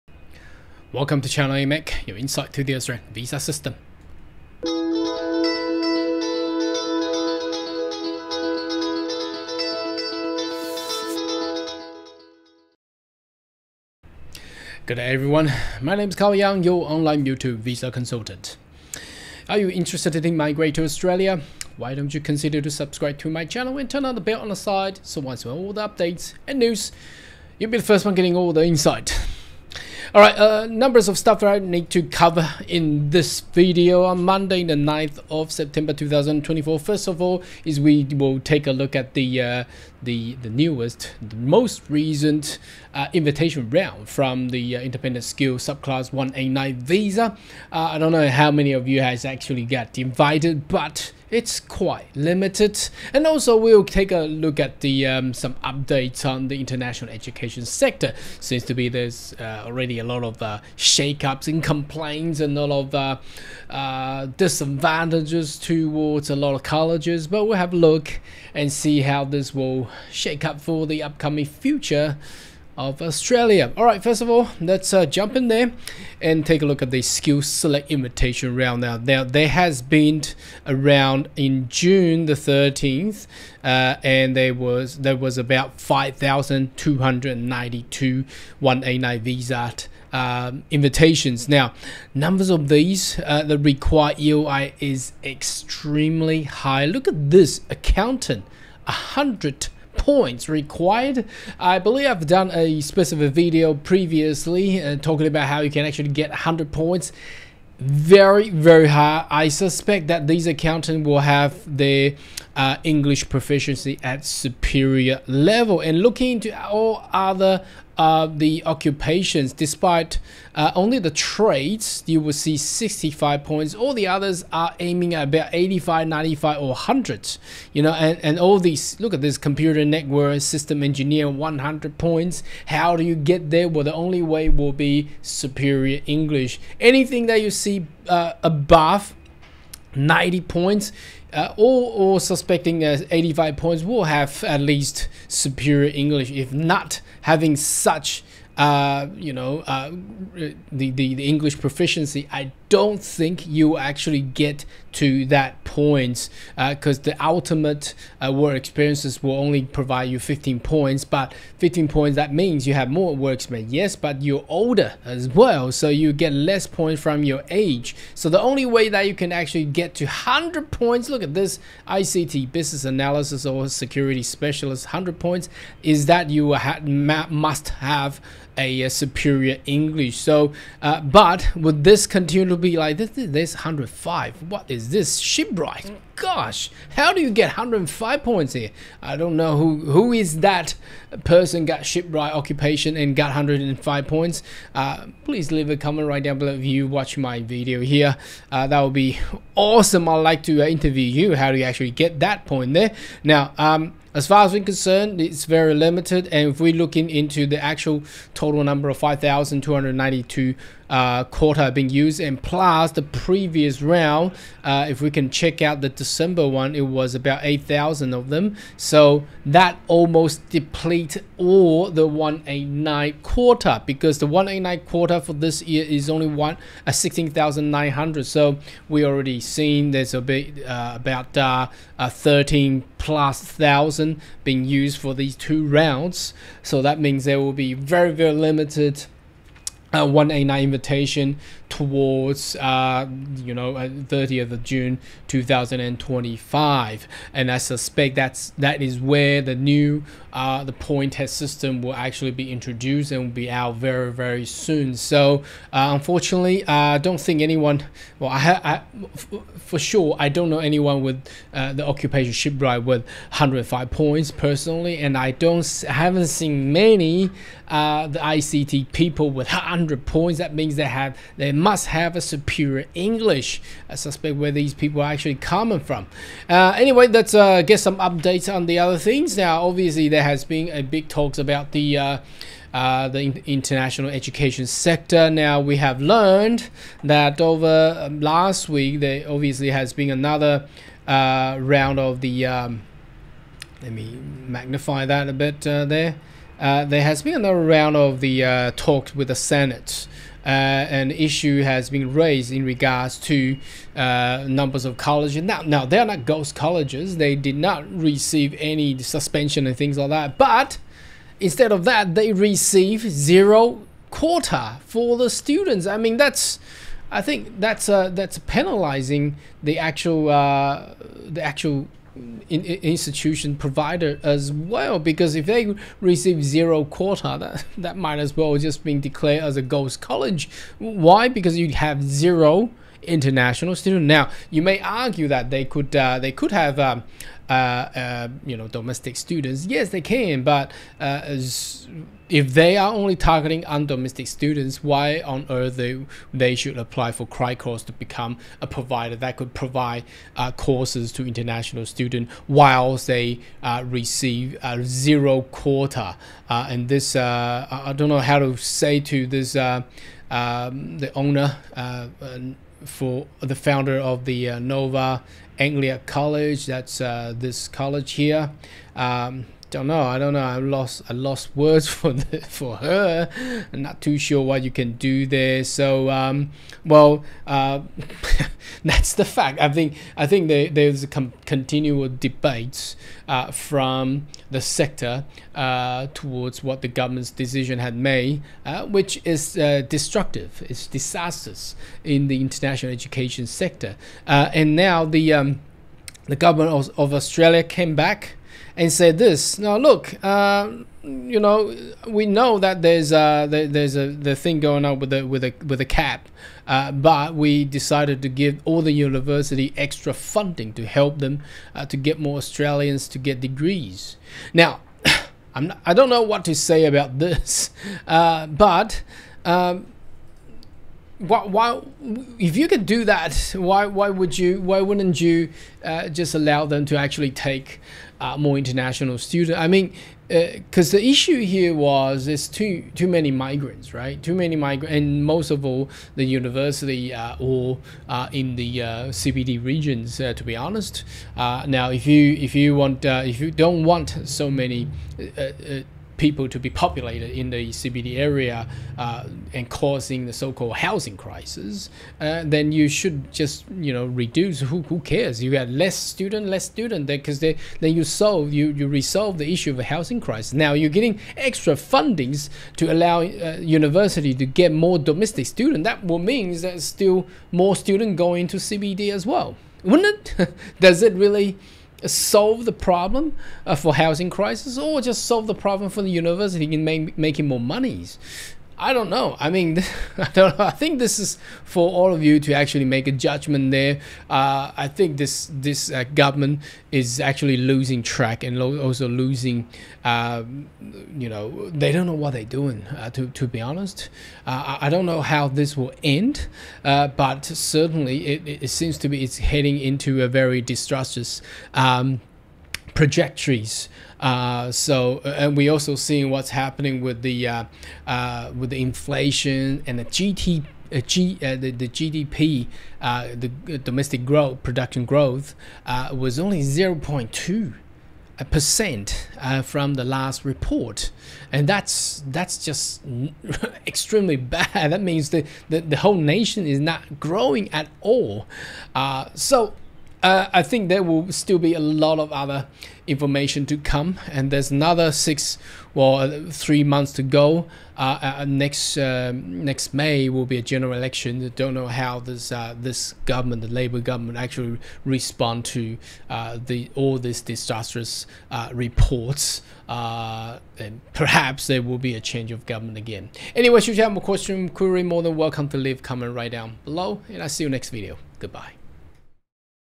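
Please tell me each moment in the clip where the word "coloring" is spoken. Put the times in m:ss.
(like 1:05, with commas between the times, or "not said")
not said.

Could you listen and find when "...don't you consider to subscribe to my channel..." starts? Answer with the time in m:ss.
0:21.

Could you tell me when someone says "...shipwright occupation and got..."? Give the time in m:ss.
3:11.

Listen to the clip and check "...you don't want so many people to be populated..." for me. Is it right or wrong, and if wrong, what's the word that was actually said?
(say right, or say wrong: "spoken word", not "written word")
right.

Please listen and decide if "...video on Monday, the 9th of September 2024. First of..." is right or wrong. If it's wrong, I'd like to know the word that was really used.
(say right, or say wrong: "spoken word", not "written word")
right.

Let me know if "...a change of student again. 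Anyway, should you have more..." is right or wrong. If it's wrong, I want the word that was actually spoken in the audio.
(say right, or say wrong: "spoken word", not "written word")
wrong: "government", not "student".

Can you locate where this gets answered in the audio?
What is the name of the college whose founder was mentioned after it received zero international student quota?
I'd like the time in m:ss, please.
6:04.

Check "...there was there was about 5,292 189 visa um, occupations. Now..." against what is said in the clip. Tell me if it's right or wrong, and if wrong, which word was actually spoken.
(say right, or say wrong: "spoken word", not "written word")
wrong: "invitations", not "occupations".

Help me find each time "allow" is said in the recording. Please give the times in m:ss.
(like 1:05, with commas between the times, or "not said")
7:06, 7:42.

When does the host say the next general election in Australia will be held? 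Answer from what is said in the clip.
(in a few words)
next May.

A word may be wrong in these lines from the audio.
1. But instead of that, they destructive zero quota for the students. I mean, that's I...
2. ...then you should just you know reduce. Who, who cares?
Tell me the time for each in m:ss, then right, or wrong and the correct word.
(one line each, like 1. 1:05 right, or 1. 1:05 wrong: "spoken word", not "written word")
1. 5:10 wrong: "receive", not "destructive"
2. 7:32 right.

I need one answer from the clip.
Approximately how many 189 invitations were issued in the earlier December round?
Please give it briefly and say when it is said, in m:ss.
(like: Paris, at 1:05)
8,000, at 3:37.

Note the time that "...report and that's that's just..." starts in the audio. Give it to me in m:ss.
8:40.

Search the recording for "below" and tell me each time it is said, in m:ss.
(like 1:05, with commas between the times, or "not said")
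3:16, 9:16.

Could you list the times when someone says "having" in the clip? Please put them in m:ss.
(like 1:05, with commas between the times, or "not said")
2:27.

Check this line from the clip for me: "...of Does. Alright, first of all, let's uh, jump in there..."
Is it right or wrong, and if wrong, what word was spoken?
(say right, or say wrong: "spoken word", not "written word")
wrong: "Australia", not "Does".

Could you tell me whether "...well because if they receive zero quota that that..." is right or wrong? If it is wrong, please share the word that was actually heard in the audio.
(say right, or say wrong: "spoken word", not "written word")
right.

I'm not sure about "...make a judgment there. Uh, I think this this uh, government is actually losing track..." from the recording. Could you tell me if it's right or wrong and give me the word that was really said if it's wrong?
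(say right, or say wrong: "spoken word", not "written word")
right.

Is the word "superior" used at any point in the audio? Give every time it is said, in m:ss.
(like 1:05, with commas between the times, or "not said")
1:54, 2:15, 2:25, 2:58, 4:32.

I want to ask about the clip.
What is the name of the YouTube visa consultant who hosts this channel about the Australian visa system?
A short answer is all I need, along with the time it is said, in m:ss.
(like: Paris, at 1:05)
Carl Yang, at 0:16.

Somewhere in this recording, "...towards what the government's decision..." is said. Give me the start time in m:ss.
6:26.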